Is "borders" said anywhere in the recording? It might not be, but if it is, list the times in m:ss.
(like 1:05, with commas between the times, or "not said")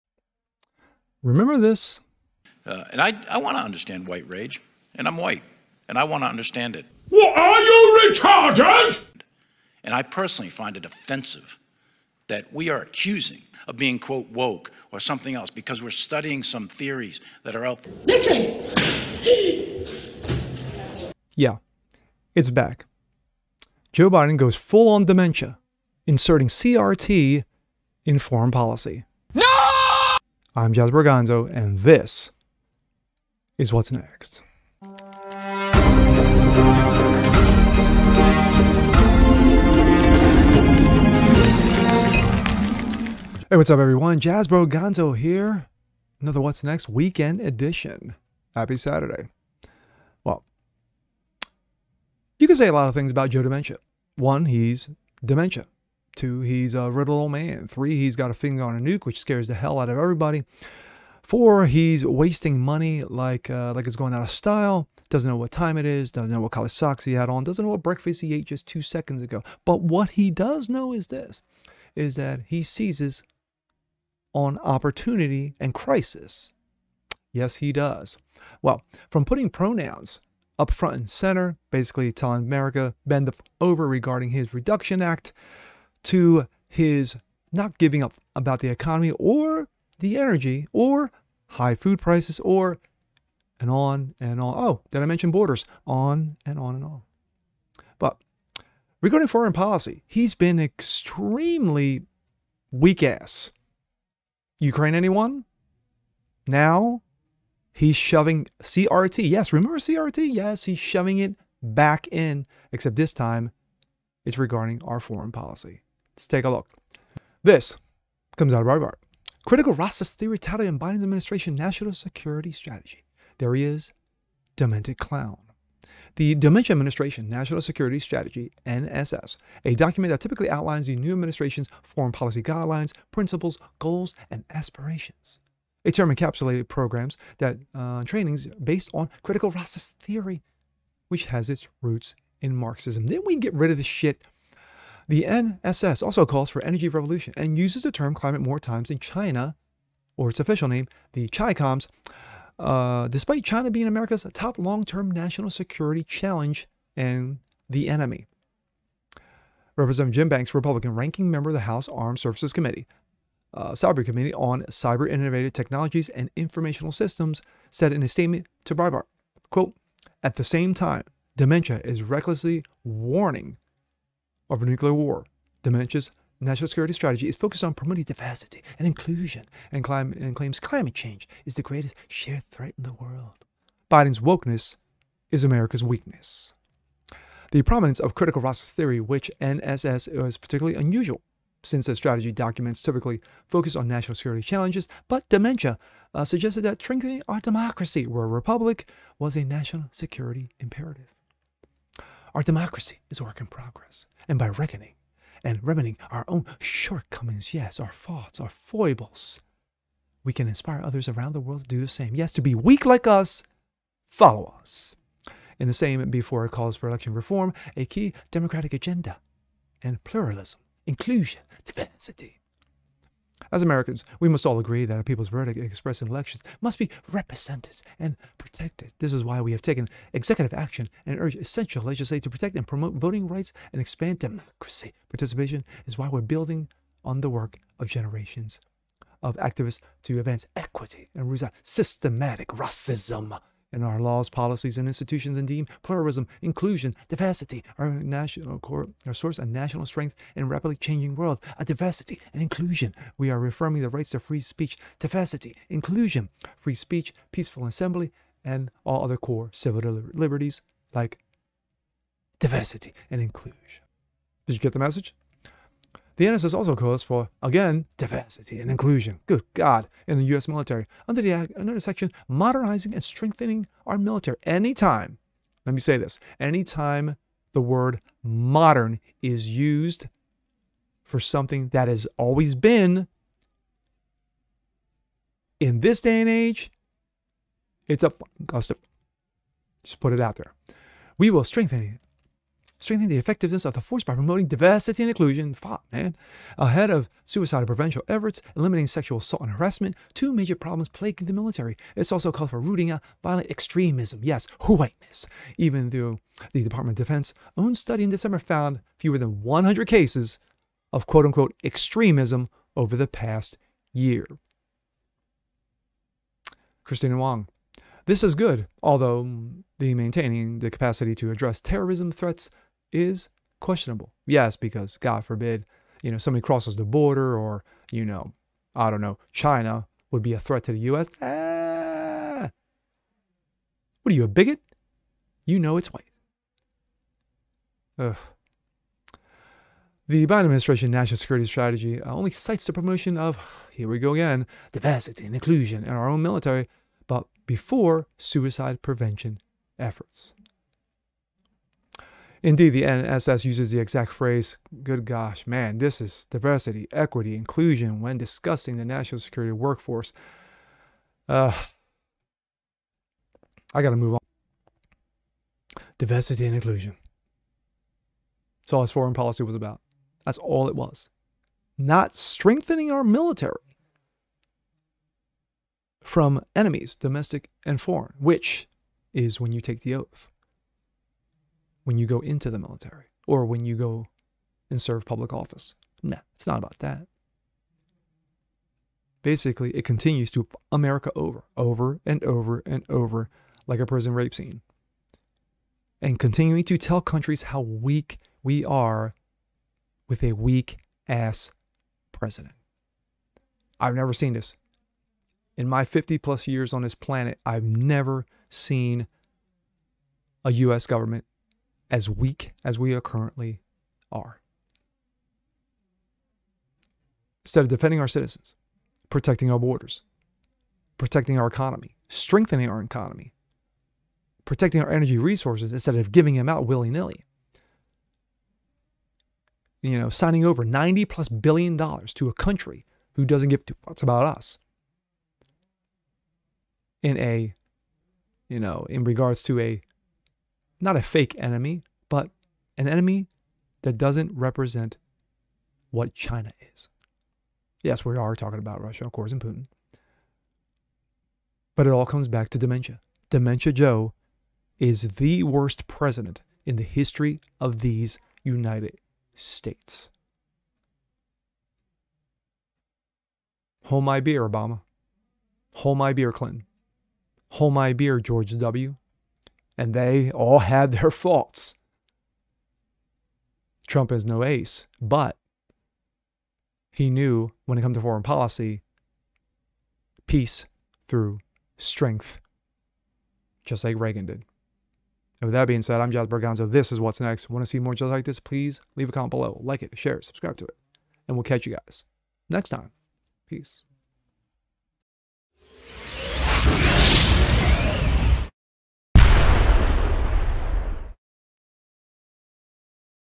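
1:35, 5:26, 6:59.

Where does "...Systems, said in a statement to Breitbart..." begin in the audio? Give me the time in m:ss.
2:46.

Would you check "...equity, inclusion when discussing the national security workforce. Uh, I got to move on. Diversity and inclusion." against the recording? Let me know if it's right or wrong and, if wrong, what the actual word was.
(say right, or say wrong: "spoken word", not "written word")
right.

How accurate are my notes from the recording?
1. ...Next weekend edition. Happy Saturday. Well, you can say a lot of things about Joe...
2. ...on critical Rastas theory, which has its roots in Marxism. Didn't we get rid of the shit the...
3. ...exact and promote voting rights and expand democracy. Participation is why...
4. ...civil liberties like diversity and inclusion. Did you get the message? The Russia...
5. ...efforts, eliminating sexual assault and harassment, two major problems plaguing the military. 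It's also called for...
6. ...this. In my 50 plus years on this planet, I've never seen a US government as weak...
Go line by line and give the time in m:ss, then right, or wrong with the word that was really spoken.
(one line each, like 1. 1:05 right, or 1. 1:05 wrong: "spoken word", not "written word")
1. 0:46 right
2. 2:18 right
3. 3:52 wrong: "protect", not "exact"
4. 4:19 wrong: "NSS", not "Russia"
5. 4:58 right
6. 6:44 right.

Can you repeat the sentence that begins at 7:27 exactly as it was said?
Yes, we are talking about Russia, of course, and Putin.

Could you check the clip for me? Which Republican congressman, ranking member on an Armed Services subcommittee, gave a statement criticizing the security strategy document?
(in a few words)
Jim Banks.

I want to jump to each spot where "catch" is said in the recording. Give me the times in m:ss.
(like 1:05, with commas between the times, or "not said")
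8:11.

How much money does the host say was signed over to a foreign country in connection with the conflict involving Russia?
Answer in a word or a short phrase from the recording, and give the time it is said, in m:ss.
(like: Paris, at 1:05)
90 plus billion dollars, at 7:10.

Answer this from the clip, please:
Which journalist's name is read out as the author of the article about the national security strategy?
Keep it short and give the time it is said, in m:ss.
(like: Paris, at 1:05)
Kristina Wong, at 5:16.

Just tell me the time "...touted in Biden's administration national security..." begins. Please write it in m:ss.
2:00.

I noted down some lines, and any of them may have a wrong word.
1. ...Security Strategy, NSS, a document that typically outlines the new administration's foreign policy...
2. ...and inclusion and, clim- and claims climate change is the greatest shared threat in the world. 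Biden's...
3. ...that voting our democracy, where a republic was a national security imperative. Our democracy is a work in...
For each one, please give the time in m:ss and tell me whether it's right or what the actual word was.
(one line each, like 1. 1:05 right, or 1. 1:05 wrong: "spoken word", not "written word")
1. 2:07 right
2. 2:58 right
3. 3:16 wrong: "strengthening", not "voting".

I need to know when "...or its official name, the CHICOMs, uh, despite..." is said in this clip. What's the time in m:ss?
2:30.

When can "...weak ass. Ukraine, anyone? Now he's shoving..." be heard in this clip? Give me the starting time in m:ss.
1:42.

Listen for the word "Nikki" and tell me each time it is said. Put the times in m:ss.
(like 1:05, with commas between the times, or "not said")
0:18.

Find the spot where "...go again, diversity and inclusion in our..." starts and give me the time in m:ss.
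5:43.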